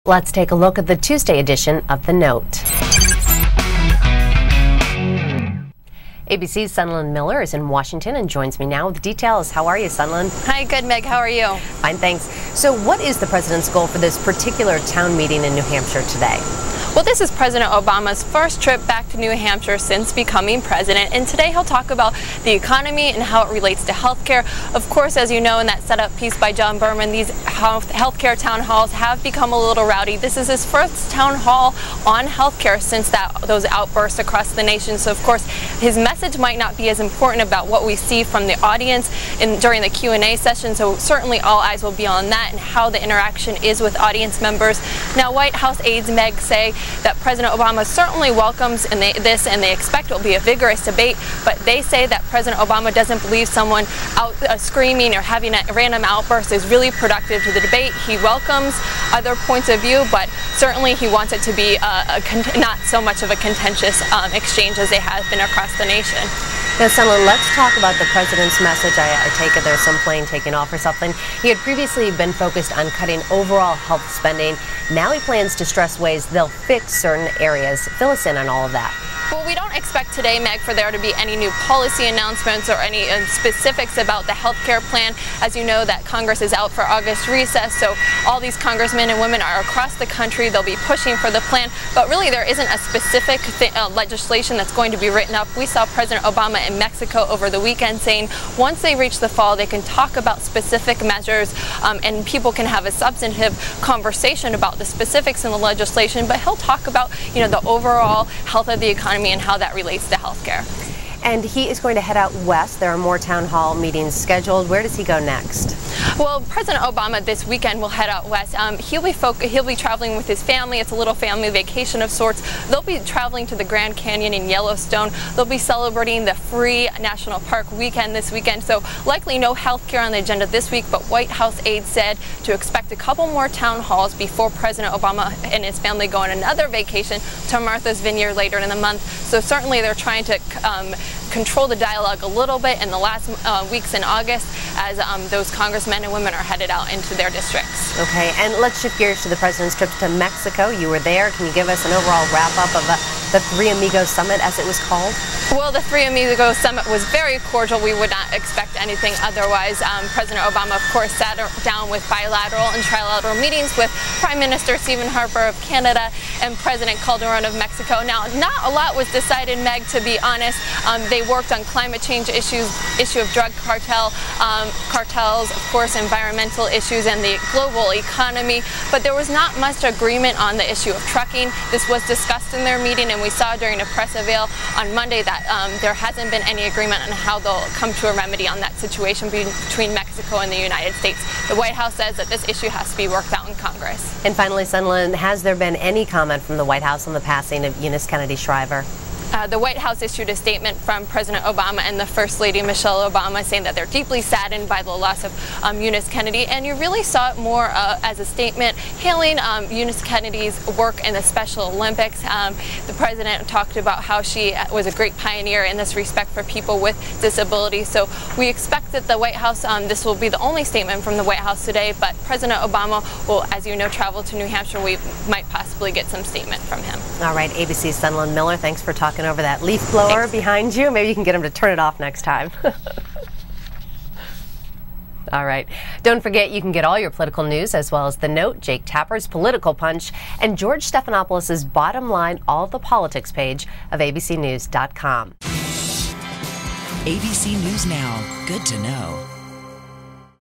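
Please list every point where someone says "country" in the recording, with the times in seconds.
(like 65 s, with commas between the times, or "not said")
90 s.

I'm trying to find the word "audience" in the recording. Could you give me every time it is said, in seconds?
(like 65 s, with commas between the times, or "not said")
38 s, 43 s.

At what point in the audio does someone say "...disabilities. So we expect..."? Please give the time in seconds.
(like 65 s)
217 s.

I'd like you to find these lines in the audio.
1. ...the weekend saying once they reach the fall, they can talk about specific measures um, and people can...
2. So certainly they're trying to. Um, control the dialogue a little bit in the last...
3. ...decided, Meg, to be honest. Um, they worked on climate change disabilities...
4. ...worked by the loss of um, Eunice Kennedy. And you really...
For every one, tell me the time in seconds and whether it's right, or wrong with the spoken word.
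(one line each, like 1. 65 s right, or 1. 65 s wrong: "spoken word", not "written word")
1. 97 s right
2. 139 s right
3. 169 s wrong: "issues", not "disabilities"
4. 204 s wrong: "saddened", not "worked".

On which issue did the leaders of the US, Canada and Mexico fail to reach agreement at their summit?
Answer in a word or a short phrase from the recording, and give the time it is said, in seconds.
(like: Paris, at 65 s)
Trucking, at 181 s.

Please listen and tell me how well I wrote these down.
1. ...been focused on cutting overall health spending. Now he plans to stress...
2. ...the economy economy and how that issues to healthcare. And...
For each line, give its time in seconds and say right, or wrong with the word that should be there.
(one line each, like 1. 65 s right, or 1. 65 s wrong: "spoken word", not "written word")
1. 72 s right
2. 108 s wrong: "relates", not "issues".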